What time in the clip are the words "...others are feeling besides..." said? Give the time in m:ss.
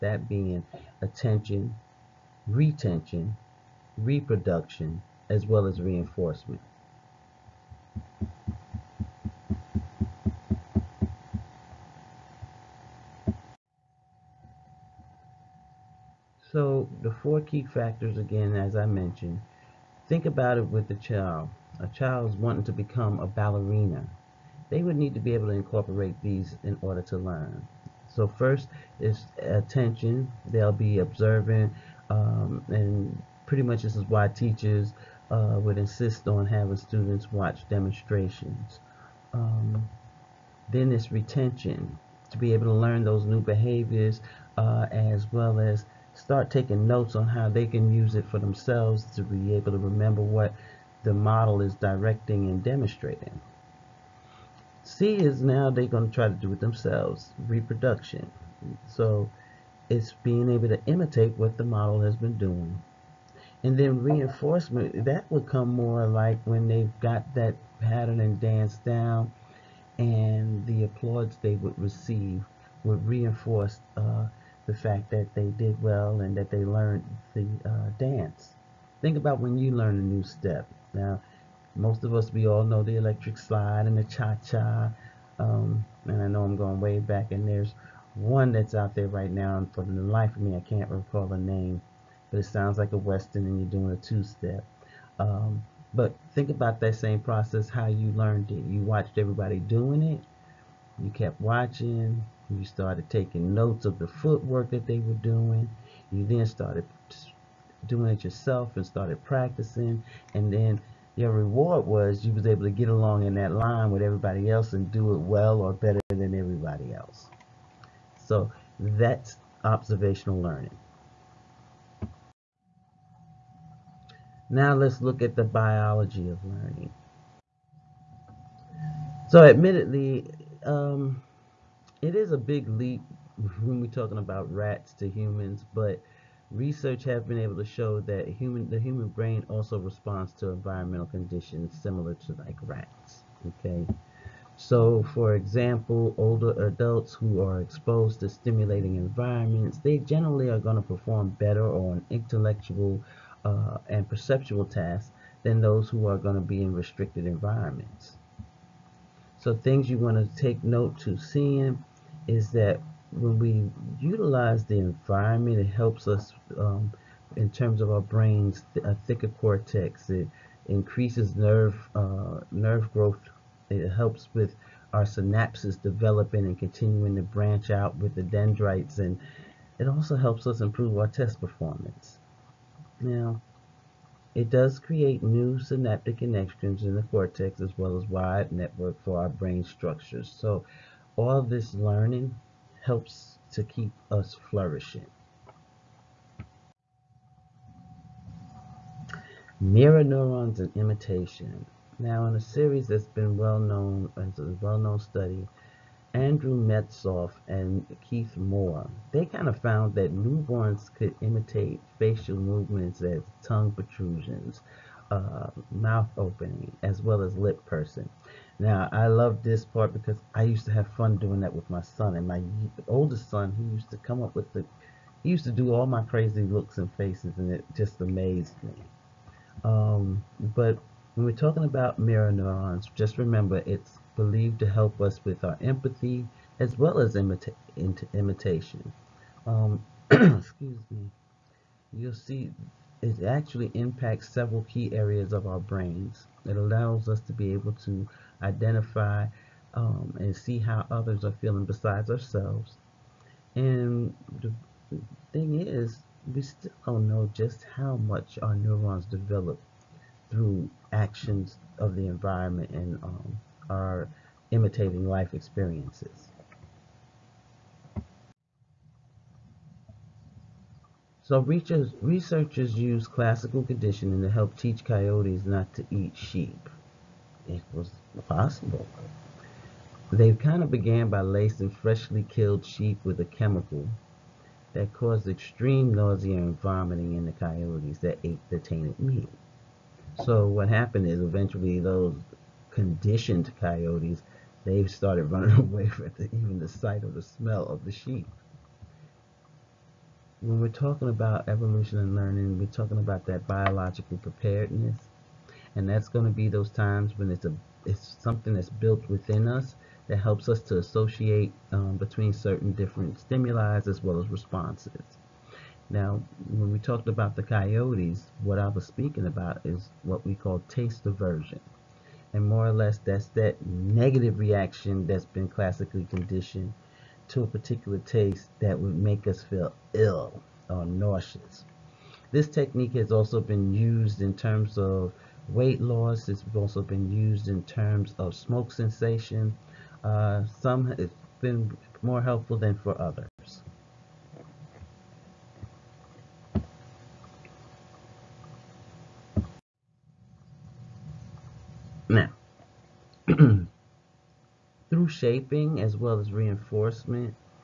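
4:10.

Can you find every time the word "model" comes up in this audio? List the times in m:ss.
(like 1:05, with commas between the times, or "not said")
0:51, 1:01.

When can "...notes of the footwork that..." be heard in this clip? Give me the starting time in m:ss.
1:43.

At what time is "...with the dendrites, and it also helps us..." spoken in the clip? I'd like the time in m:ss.
2:57.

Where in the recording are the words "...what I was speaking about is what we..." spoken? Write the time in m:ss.
5:18.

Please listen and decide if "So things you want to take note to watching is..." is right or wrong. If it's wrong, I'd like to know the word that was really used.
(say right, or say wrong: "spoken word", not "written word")
wrong: "seeing", not "watching".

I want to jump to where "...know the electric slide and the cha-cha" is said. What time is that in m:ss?
1:22.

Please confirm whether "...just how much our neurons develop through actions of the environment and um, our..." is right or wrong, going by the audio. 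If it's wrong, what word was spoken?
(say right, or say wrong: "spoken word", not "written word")
right.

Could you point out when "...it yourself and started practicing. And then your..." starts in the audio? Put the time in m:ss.
1:48.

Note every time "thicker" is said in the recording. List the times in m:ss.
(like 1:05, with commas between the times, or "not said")
2:49.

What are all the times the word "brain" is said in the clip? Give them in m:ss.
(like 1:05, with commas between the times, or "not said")
2:19, 2:48, 3:09, 4:05.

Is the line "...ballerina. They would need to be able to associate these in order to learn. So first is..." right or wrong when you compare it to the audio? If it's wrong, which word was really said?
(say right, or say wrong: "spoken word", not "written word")
wrong: "incorporate", not "associate".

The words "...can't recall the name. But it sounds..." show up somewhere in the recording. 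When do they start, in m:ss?
1:30.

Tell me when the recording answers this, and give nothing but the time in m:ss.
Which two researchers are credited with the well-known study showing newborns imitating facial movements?
3:26.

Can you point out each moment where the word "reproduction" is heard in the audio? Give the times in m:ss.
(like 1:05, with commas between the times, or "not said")
0:03, 0:57.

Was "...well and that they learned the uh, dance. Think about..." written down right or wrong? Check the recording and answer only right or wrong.
right.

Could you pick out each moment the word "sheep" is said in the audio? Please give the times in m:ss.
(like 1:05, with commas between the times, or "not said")
4:36, 4:42, 4:57.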